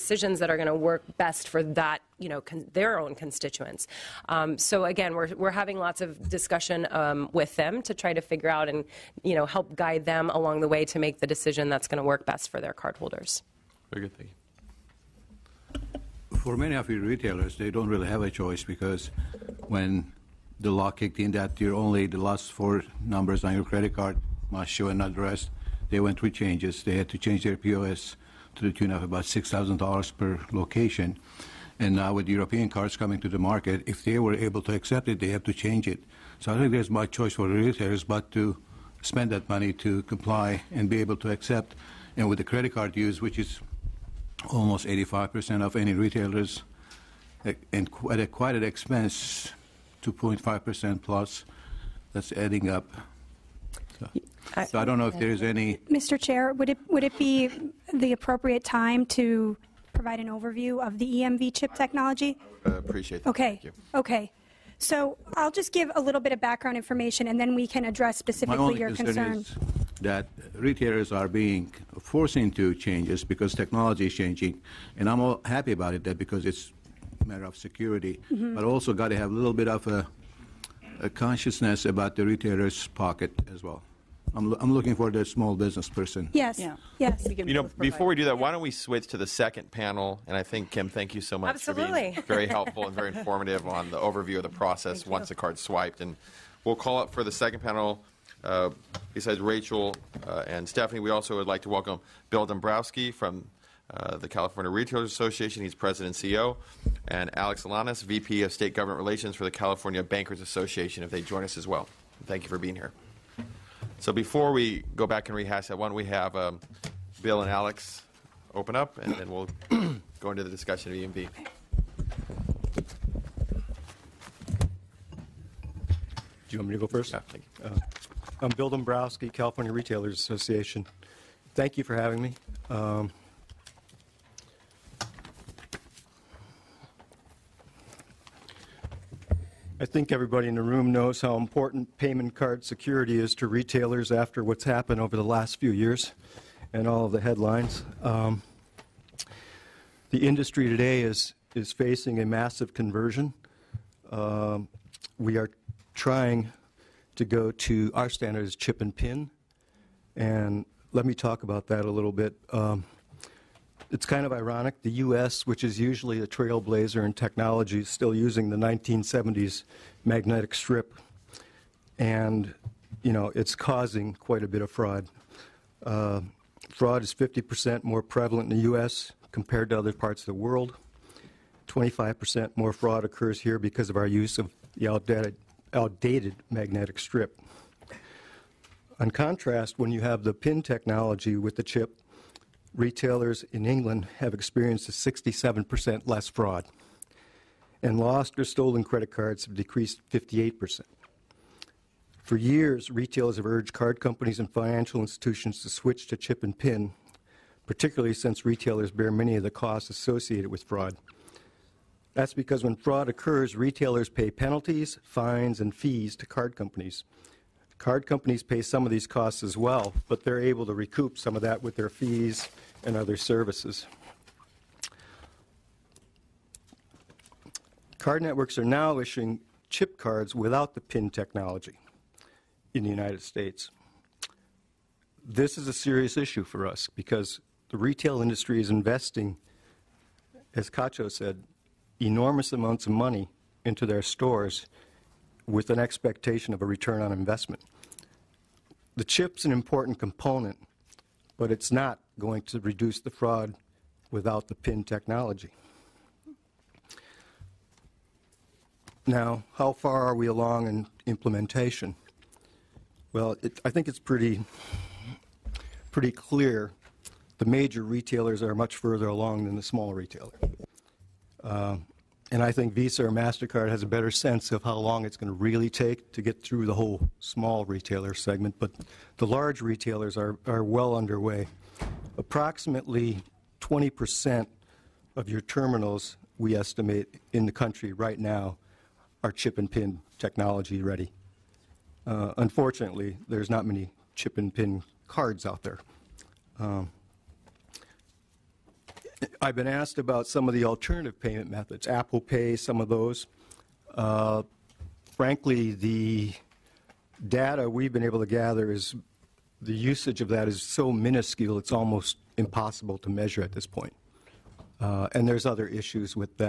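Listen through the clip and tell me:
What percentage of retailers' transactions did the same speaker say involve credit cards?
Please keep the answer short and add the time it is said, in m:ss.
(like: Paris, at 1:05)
85%, at 0:44.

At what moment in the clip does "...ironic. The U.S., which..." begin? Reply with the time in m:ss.
2:44.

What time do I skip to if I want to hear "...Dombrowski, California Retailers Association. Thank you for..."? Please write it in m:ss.
2:08.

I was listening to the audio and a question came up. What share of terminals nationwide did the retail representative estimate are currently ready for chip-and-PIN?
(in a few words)
20%.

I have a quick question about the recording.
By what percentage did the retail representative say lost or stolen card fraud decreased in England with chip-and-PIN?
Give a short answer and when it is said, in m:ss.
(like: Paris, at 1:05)
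58%, at 3:20.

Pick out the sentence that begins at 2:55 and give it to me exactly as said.
Uh, fraud is 50% more prevalent in the U.S.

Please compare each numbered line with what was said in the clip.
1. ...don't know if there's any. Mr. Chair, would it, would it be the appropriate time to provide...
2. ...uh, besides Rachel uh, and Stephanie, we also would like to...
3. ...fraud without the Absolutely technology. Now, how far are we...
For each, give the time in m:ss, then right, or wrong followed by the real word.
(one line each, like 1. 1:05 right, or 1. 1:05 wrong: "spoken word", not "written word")
1. 0:54 right
2. 1:38 right
3. 4:13 wrong: "PIN", not "Absolutely".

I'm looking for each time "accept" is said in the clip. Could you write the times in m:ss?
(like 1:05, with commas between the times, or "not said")
0:34, 0:41.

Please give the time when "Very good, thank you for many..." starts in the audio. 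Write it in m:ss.
0:13.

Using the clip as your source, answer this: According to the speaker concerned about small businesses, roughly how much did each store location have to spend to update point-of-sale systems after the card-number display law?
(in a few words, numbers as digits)
$6,000.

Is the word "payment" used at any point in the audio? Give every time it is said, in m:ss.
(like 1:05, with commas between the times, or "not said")
2:21, 5:01.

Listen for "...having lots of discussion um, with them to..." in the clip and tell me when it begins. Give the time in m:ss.
0:05.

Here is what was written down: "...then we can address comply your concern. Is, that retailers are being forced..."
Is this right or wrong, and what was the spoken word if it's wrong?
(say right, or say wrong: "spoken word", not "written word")
wrong: "specifically", not "comply".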